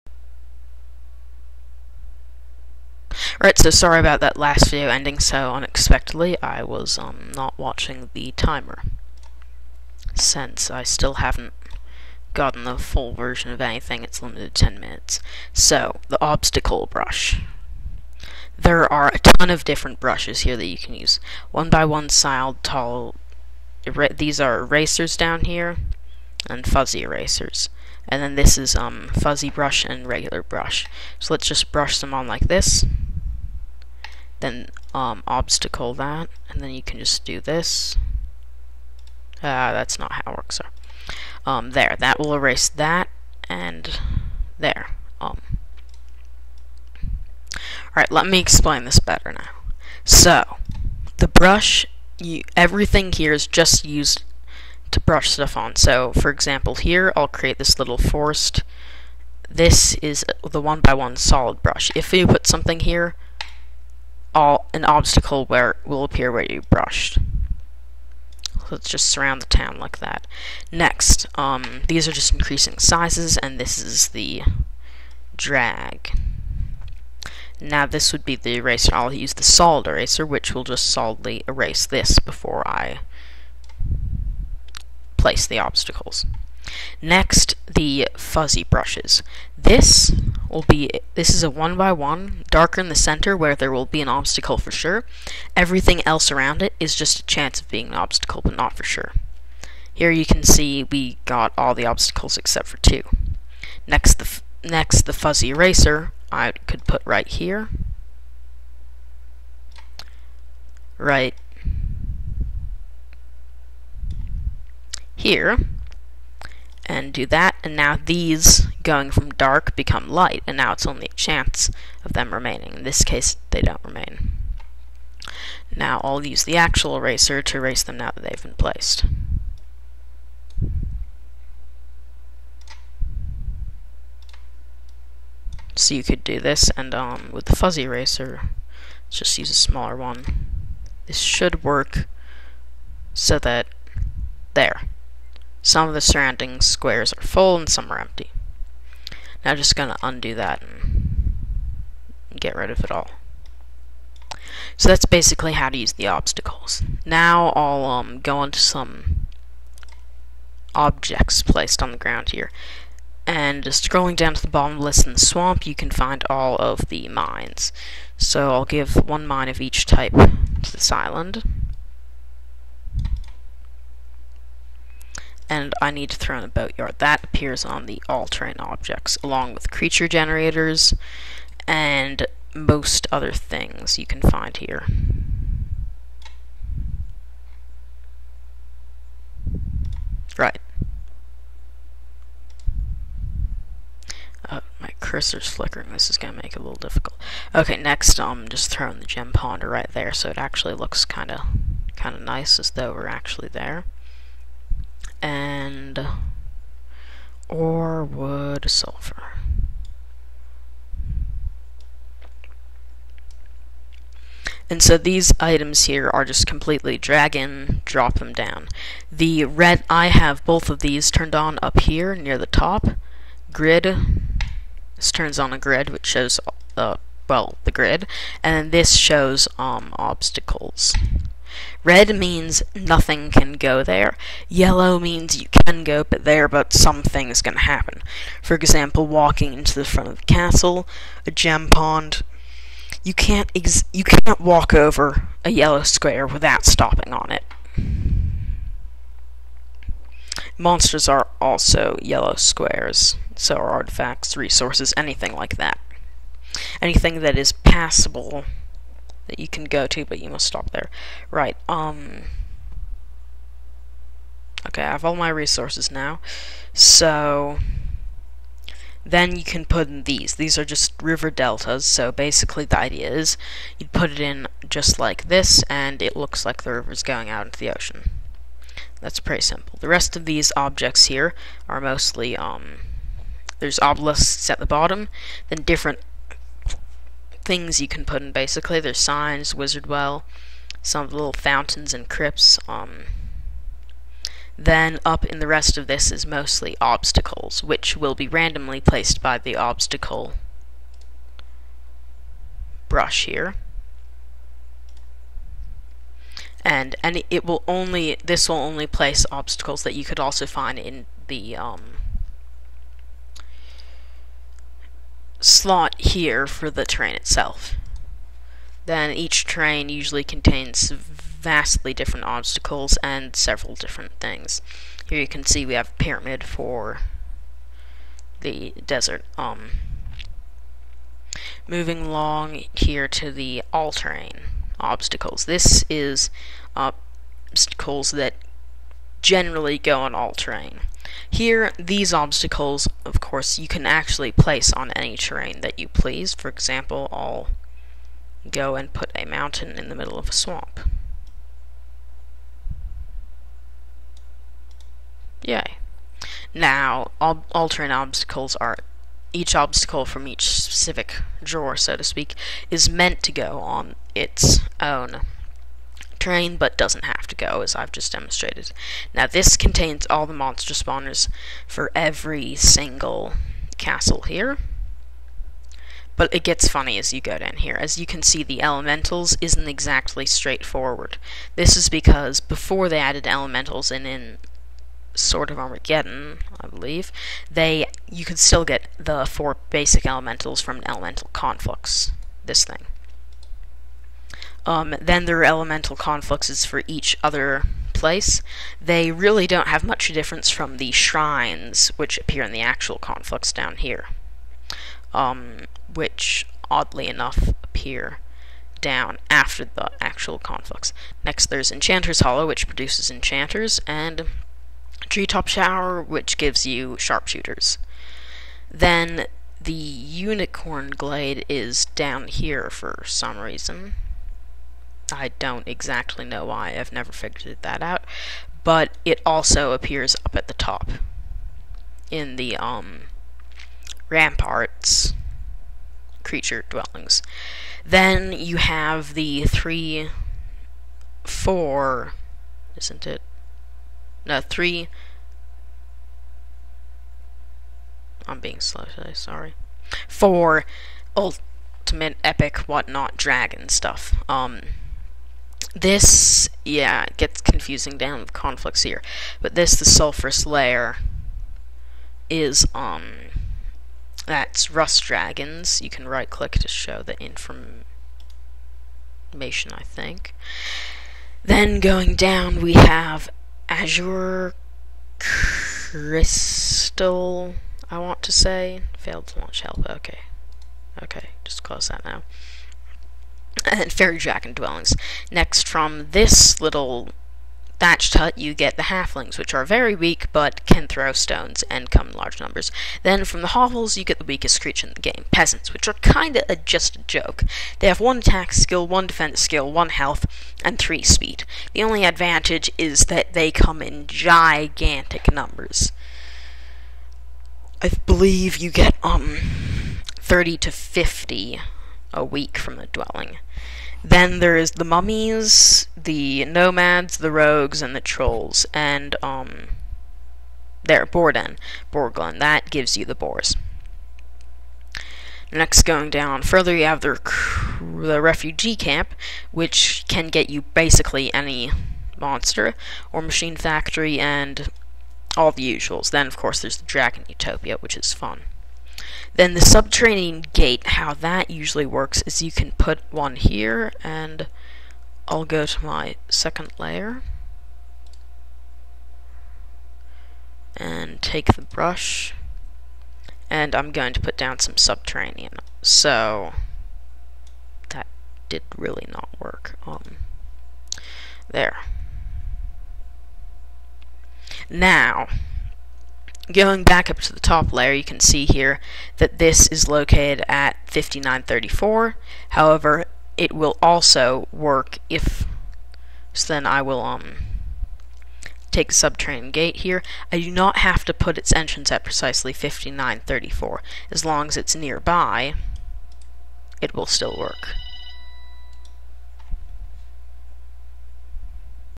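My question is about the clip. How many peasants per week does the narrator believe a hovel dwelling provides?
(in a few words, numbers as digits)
30 to 50.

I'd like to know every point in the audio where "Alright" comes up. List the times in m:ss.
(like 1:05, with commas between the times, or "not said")
0:03, 0:47.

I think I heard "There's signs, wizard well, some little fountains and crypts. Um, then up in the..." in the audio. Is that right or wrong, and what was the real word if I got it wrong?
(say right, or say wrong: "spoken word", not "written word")
right.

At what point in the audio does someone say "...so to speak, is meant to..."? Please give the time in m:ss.
6:01.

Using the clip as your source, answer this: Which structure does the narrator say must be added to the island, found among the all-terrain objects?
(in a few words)
boatyard.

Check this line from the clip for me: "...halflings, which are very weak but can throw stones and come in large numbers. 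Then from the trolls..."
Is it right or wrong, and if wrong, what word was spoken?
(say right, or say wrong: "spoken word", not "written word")
wrong: "hovels", not "trolls".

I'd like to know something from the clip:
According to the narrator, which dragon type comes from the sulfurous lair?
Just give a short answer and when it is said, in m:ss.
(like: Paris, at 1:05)
Rust Dragons, at 7:44.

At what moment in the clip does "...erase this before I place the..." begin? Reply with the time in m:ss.
1:21.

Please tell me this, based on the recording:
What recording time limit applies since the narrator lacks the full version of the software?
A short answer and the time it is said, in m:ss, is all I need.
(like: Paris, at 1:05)
10 minutes, at 0:14.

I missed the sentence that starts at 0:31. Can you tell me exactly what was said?
So let's just brush them on like this then um, obstacle that, and then you can just do this.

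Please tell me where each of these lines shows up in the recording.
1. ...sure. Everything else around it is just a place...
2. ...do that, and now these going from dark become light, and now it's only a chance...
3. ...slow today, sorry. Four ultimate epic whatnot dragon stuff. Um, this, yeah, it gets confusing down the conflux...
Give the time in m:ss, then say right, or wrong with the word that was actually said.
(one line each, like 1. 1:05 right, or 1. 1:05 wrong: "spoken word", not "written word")
1. 1:34 wrong: "chance", not "place"
2. 1:57 right
3. 7:28 right.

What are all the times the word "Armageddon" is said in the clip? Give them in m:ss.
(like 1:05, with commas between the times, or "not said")
6:25.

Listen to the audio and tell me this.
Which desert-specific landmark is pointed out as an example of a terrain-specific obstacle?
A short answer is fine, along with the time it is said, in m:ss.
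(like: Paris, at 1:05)
pyramid, at 5:26.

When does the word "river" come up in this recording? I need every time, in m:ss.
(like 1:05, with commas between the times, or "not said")
4:31, 4:36.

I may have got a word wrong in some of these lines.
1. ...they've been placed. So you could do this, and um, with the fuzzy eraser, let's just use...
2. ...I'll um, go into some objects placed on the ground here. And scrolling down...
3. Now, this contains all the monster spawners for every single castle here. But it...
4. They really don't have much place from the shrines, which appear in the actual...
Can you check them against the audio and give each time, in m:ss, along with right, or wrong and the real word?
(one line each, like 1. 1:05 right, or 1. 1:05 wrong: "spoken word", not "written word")
1. 2:08 right
2. 2:37 right
3. 6:09 right
4. 6:38 wrong: "difference", not "place".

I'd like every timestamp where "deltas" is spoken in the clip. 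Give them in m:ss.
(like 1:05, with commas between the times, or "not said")
4:31.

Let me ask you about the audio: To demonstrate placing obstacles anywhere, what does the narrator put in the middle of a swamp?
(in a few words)
a mountain.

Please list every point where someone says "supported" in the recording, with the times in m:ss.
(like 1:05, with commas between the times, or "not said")
not said.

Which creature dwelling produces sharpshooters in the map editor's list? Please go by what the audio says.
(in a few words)
Treetop Tower.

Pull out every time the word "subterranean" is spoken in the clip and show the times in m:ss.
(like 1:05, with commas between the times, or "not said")
8:59, 9:14, 9:38.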